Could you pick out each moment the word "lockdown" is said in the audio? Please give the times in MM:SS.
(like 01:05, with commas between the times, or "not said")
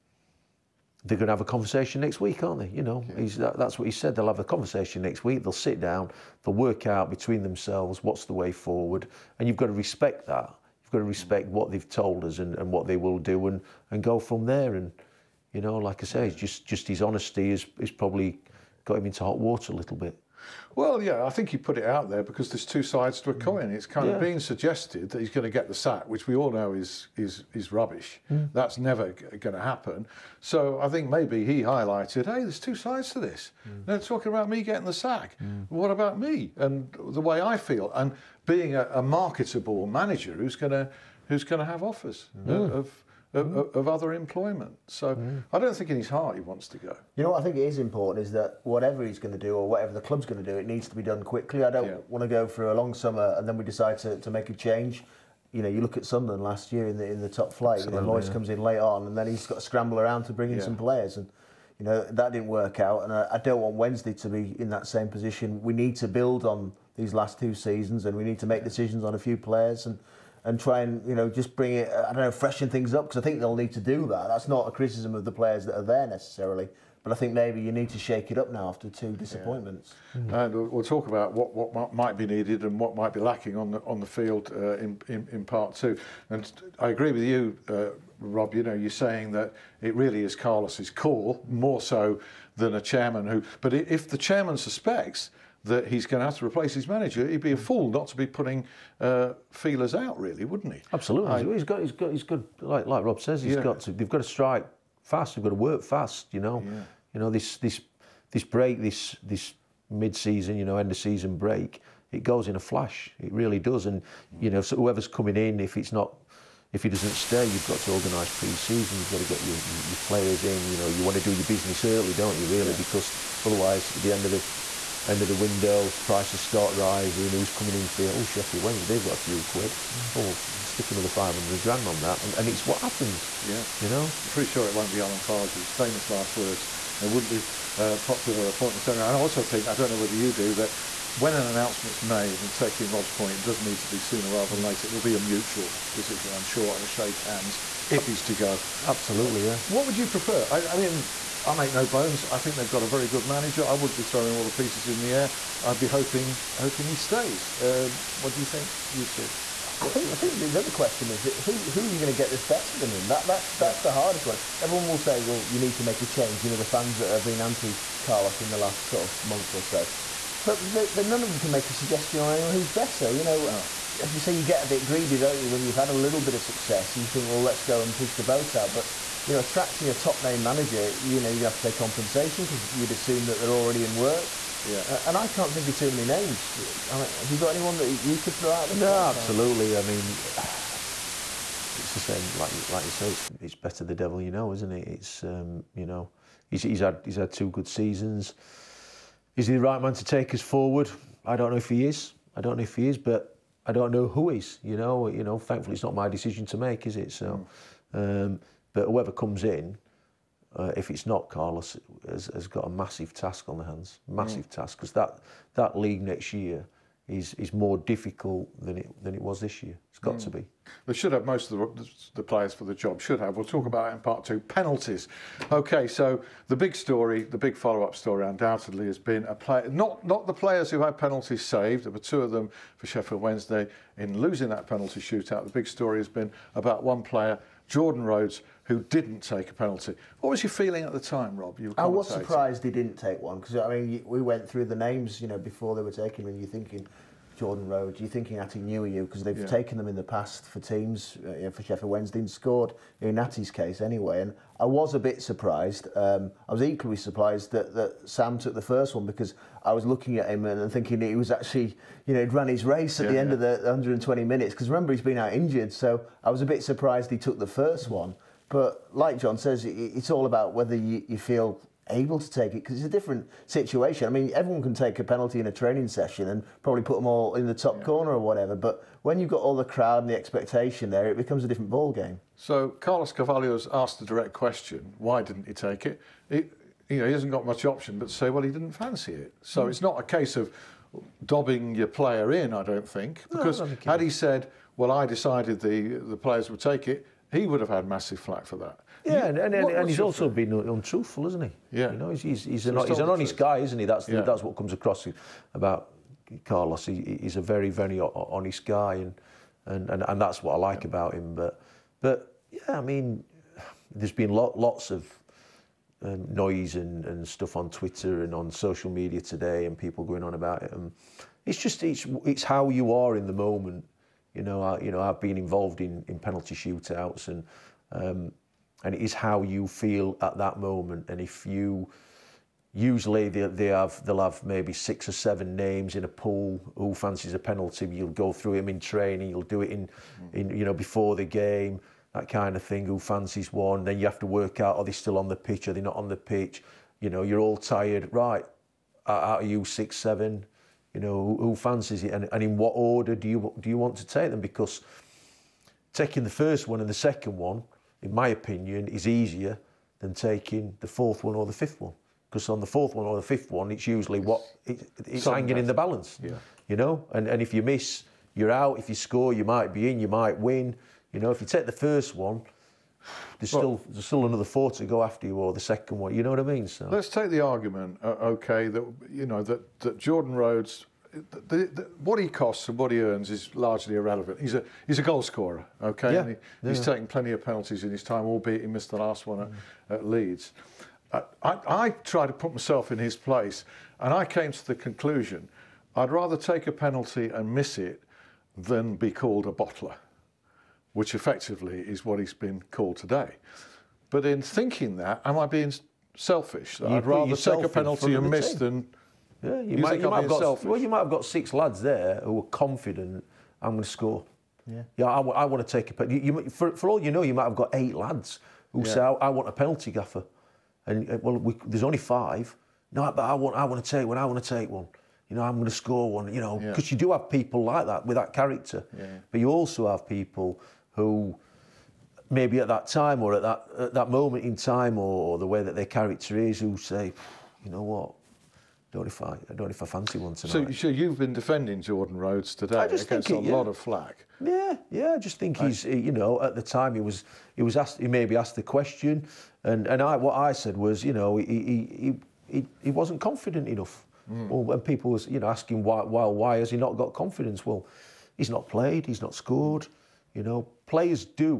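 not said.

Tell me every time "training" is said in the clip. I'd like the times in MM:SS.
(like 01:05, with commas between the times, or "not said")
04:35, 05:38.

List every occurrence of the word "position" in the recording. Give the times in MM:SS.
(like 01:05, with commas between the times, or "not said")
01:05.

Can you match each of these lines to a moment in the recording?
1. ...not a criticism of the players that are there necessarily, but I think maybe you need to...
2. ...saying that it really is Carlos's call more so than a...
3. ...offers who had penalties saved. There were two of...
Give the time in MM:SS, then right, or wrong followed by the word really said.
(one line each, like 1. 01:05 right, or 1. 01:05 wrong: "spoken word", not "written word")
1. 01:14 right
2. 01:28 right
3. 03:50 wrong: "players", not "offers".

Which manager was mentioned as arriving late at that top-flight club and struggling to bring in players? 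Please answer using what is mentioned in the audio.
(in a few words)
Moyes.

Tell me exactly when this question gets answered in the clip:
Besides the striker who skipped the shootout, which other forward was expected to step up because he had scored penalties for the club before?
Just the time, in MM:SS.
04:08.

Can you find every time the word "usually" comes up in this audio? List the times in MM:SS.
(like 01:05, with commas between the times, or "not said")
05:32, 06:03.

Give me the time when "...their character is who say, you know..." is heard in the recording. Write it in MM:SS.
07:15.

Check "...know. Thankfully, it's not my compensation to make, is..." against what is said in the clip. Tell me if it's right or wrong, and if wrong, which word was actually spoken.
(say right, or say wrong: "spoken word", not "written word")
wrong: "decision", not "compensation".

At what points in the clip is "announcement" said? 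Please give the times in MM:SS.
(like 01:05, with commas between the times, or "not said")
02:21.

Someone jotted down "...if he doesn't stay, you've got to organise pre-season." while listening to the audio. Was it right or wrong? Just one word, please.
right.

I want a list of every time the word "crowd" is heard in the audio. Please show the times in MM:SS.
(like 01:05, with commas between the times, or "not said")
04:39.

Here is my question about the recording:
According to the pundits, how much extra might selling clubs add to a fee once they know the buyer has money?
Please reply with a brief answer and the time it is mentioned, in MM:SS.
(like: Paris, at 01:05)
500 grand, at 02:11.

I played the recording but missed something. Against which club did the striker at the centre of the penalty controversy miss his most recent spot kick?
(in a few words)
Leeds.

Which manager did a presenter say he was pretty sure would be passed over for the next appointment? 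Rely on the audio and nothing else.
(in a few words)
Alan Pardew.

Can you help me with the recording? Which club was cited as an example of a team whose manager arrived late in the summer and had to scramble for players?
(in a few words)
Sunderland.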